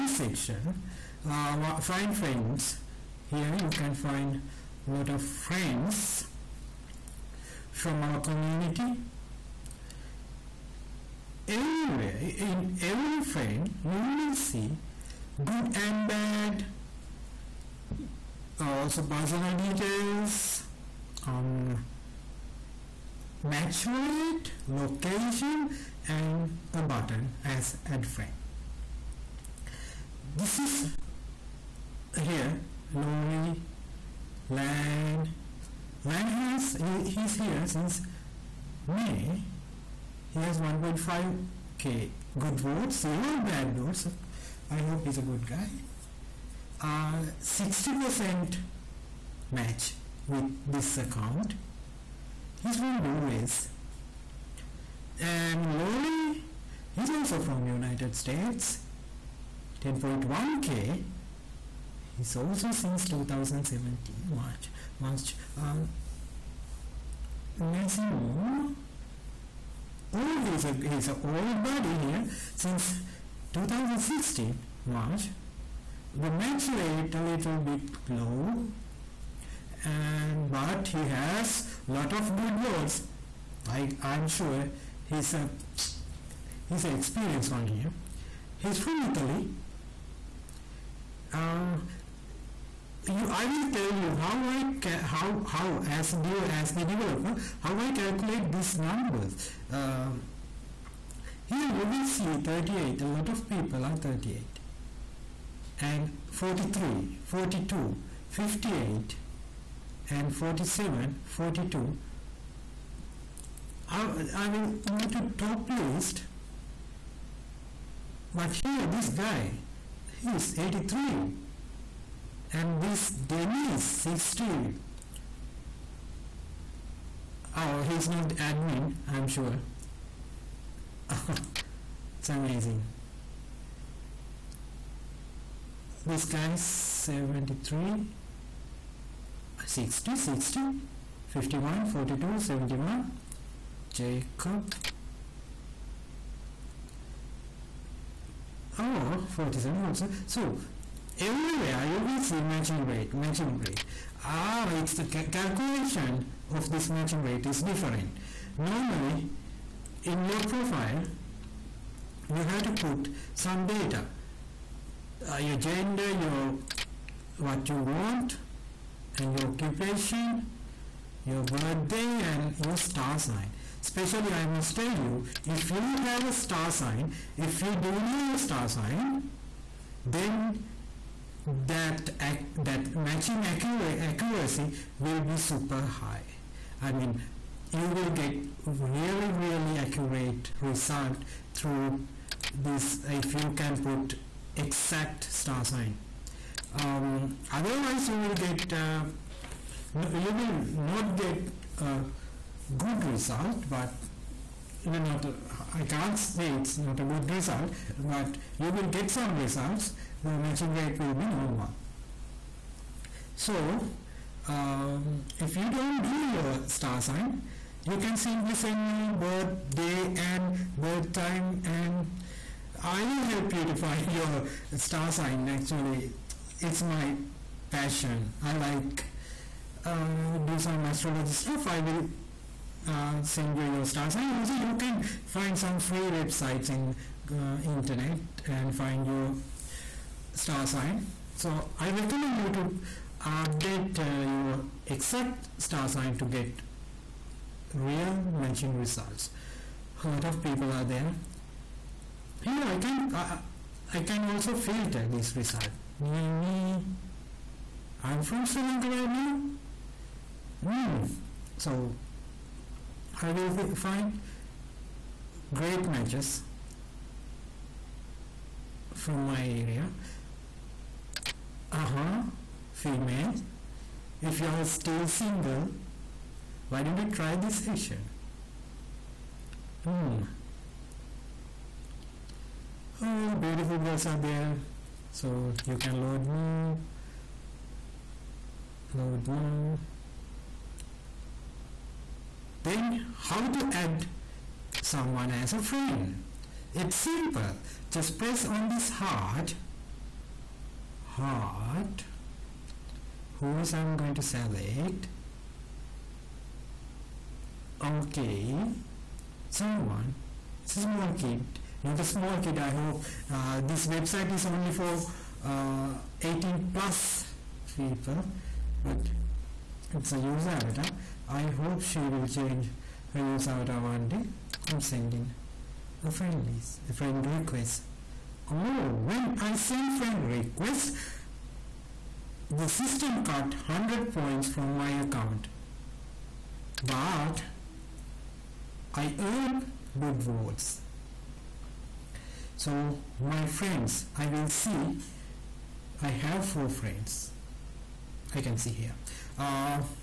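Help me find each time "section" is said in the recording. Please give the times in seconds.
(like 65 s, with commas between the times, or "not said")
0 s, 277 s.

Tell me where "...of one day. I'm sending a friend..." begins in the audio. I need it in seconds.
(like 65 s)
323 s.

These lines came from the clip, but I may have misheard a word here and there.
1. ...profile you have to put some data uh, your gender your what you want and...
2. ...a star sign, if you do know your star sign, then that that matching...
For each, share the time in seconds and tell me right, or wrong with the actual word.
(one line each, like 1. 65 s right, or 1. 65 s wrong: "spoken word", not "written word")
1. 160 s right
2. 176 s right.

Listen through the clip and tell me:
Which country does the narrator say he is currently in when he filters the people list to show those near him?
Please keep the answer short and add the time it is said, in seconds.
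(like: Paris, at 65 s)
Sri Lanka, at 258 s.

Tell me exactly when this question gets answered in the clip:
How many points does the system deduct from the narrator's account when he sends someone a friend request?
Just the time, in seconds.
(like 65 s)
333 s.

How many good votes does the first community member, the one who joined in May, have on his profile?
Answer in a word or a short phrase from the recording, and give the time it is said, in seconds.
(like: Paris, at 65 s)
1.5k, at 40 s.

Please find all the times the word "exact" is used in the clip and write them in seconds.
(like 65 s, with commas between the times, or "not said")
194 s, 244 s.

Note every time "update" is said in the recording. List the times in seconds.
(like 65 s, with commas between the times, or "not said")
243 s.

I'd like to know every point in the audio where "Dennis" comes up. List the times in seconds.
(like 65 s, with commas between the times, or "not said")
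123 s.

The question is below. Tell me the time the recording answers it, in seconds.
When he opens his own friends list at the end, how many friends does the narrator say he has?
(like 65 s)
346 s.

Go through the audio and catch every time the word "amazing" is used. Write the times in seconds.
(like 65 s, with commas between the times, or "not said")
132 s.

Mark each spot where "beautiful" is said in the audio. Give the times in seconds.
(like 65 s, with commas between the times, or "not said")
283 s.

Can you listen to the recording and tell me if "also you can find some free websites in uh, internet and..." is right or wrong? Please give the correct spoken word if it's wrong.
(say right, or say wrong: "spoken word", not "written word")
right.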